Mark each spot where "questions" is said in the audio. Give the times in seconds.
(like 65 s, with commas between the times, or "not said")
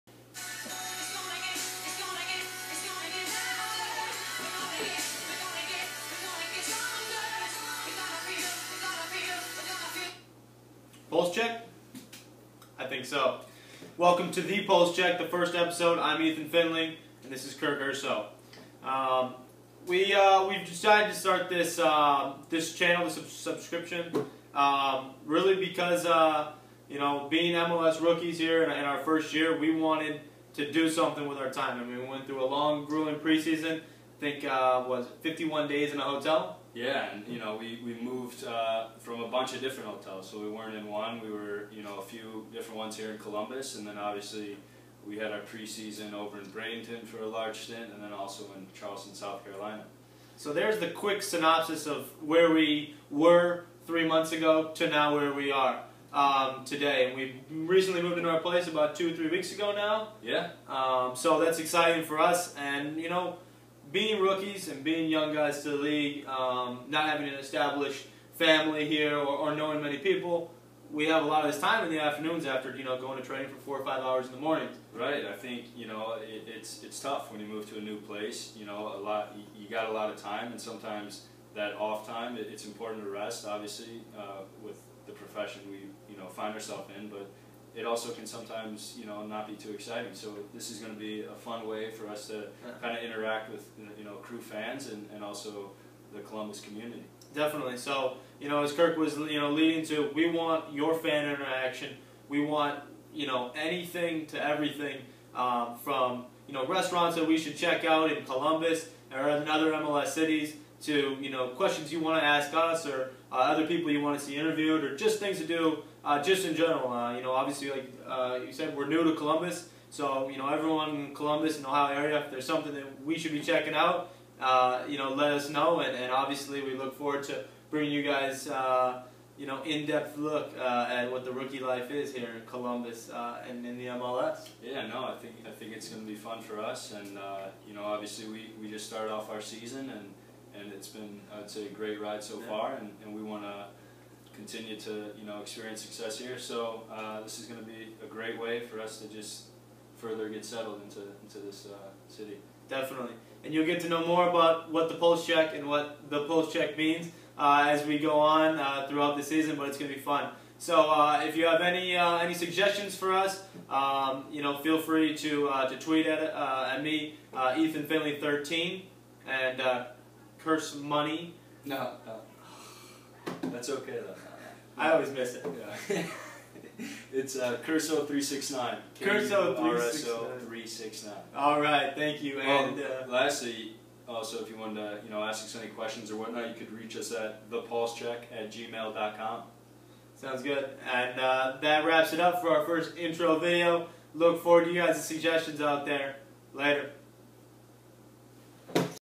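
111 s, 185 s.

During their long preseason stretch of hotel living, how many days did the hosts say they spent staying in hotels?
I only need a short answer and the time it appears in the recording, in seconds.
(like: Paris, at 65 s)
51, at 35 s.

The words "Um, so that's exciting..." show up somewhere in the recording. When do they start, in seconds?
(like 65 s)
60 s.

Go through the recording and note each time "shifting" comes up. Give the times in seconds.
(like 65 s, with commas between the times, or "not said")
not said.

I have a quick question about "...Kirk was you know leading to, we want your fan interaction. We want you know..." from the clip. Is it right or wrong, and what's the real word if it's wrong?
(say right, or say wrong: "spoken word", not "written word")
right.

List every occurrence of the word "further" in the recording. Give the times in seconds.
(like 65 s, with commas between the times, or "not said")
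149 s.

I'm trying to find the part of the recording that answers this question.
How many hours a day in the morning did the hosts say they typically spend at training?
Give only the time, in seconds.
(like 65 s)
73 s.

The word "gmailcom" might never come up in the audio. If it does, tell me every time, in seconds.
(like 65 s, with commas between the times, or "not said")
188 s.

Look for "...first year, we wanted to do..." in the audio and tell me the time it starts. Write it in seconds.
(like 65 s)
28 s.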